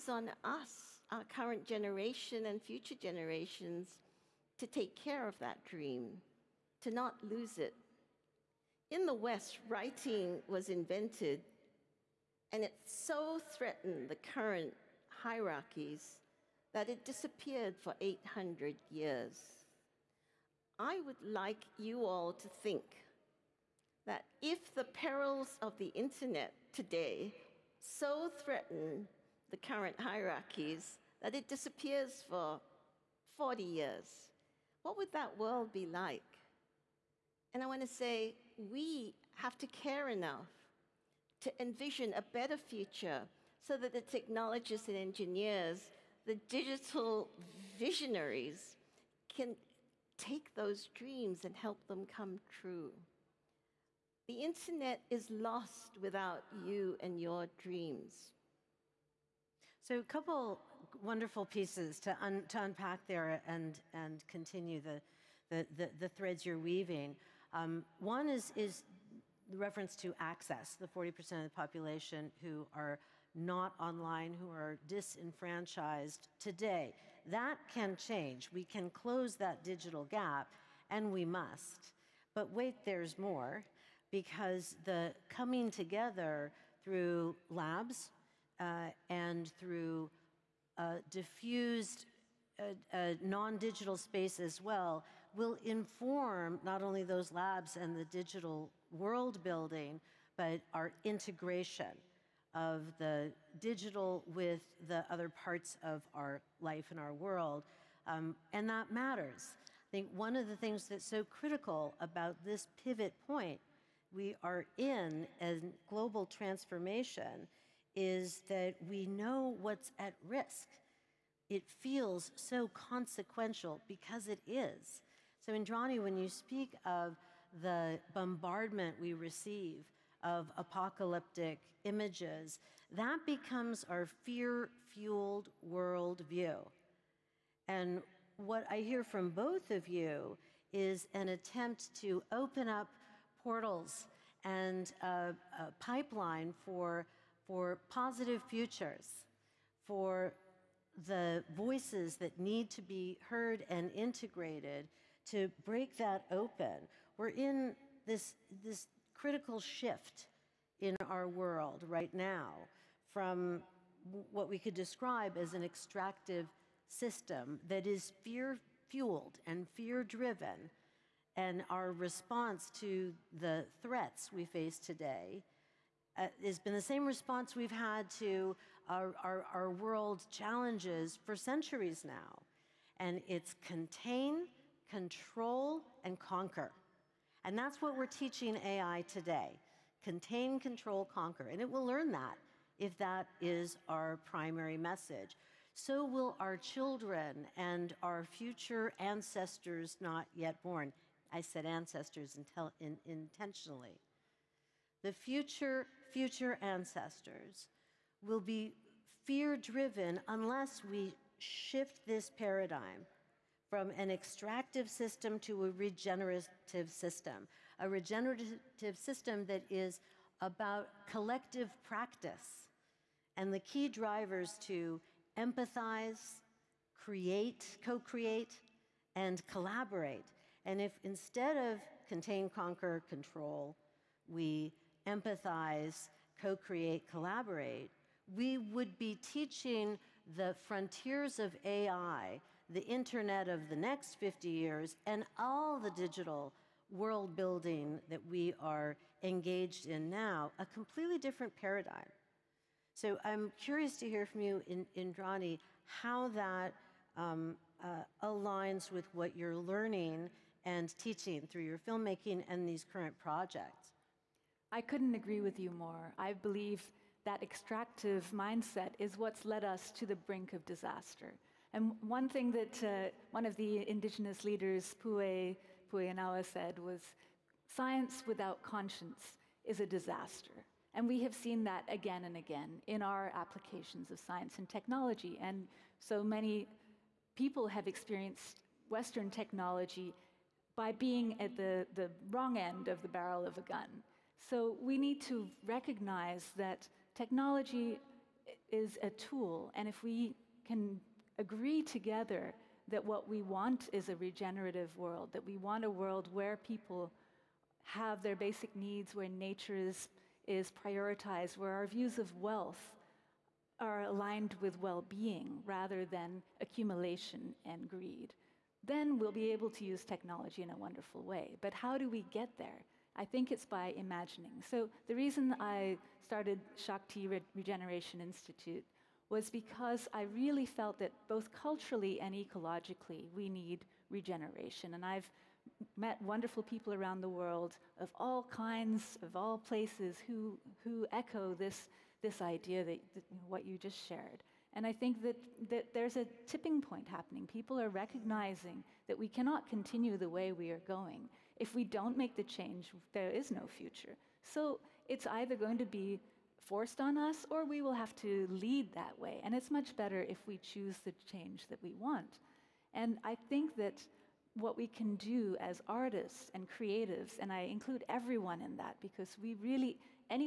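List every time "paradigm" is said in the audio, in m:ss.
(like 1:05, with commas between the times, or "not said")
3:32, 4:11.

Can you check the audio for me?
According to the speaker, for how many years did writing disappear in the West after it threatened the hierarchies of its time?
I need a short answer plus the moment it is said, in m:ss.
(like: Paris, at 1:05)
800 years, at 0:17.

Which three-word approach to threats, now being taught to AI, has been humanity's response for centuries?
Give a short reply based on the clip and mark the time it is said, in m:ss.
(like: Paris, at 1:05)
contain, control, conquer, at 3:03.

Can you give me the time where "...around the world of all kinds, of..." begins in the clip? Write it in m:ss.
5:36.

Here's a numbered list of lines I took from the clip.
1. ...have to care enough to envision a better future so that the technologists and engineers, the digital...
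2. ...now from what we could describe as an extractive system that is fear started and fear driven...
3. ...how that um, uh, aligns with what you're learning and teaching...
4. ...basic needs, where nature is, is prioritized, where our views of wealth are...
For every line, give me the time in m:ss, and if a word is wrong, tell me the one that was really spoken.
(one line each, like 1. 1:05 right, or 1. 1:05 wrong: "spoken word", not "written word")
1. 0:39 right
2. 2:42 wrong: "fueled", not "started"
3. 4:15 right
4. 5:08 right.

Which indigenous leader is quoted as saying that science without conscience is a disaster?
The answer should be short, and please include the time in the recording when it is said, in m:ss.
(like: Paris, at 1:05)
Pue Puenawa, at 4:34.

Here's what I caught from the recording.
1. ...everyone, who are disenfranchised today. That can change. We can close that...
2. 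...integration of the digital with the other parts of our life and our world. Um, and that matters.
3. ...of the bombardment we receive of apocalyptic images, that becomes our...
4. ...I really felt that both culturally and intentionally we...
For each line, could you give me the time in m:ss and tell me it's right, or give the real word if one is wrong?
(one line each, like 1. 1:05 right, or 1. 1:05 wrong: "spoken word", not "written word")
1. 1:13 wrong: "online", not "everyone"
2. 1:41 right
3. 2:06 right
4. 5:30 wrong: "ecologically", not "intentionally".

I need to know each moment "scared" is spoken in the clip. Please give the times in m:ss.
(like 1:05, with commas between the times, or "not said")
not said.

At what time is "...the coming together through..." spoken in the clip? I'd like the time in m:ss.
1:24.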